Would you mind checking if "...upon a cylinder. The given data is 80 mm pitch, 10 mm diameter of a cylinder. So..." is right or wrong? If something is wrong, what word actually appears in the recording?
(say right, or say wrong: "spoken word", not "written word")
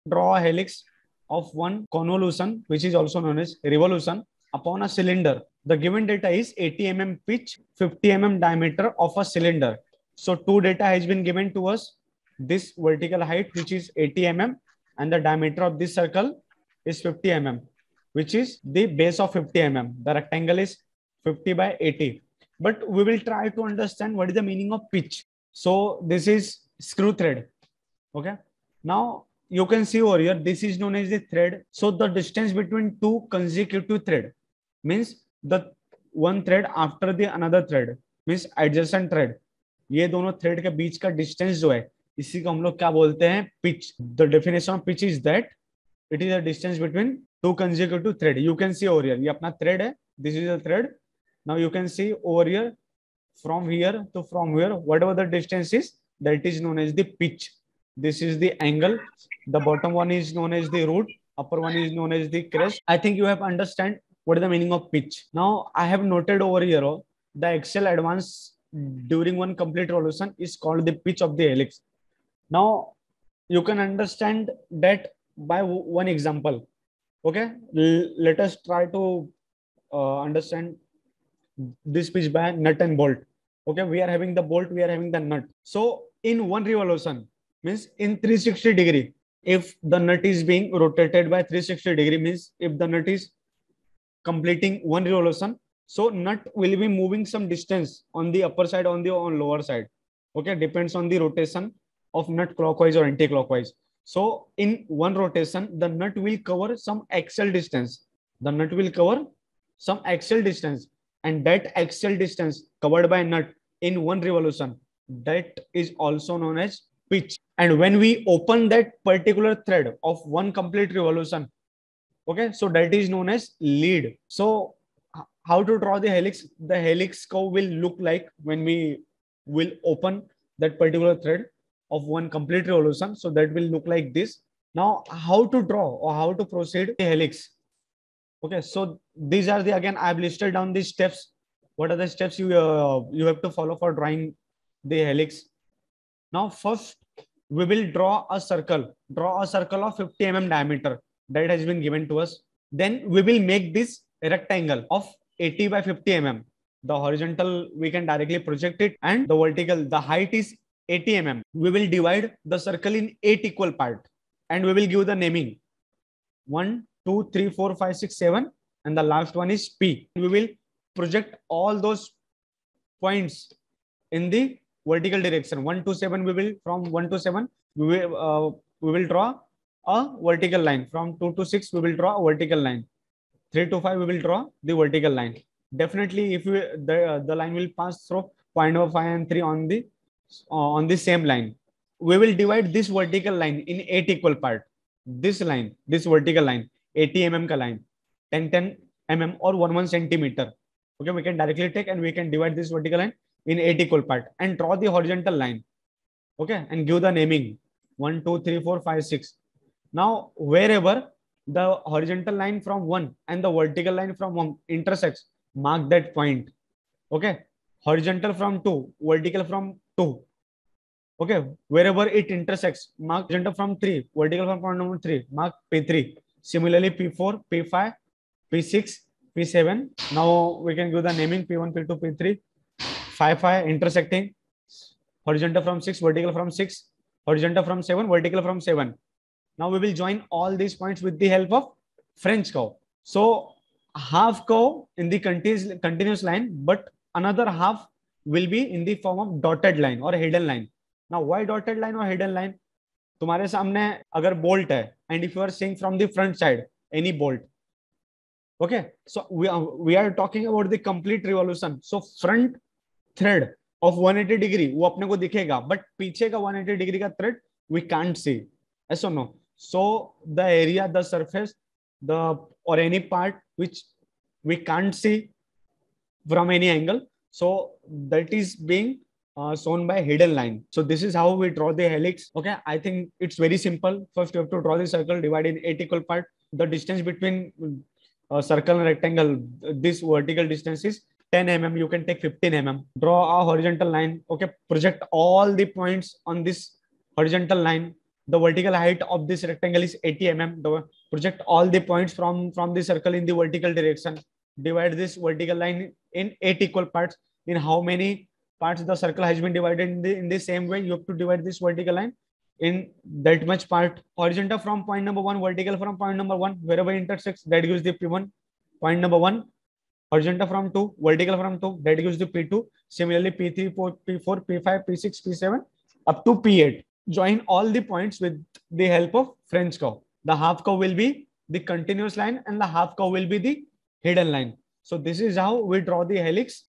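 wrong: "50", not "10".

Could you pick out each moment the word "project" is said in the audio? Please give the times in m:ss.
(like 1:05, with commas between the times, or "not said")
2:38, 2:50, 4:54, 5:01.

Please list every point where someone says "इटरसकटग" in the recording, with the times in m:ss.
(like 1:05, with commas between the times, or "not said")
3:53.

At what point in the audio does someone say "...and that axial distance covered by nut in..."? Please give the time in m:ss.
1:51.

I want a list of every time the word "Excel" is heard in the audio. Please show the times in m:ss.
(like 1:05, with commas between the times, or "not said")
1:07.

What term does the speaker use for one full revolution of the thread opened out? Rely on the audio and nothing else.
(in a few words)
Lead.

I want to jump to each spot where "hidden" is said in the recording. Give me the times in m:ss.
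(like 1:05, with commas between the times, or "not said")
4:40, 5:34.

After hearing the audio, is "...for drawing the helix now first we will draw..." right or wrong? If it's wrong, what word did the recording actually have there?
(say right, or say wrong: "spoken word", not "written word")
right.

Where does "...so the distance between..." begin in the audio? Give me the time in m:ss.
0:31.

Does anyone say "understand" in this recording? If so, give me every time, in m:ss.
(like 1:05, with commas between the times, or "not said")
0:23, 1:03, 1:13, 1:20.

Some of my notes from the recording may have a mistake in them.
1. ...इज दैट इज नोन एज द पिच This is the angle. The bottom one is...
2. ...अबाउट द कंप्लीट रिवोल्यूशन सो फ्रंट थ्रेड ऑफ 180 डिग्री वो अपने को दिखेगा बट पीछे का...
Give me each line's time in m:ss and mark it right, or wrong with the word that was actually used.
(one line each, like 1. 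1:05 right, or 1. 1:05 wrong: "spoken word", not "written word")
1. 0:55 right
2. 4:20 right.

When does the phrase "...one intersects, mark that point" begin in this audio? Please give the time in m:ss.
3:34.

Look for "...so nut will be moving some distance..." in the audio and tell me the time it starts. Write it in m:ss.
1:35.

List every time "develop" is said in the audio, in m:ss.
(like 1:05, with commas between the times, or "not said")
not said.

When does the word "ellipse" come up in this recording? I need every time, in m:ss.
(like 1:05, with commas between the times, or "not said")
1:11.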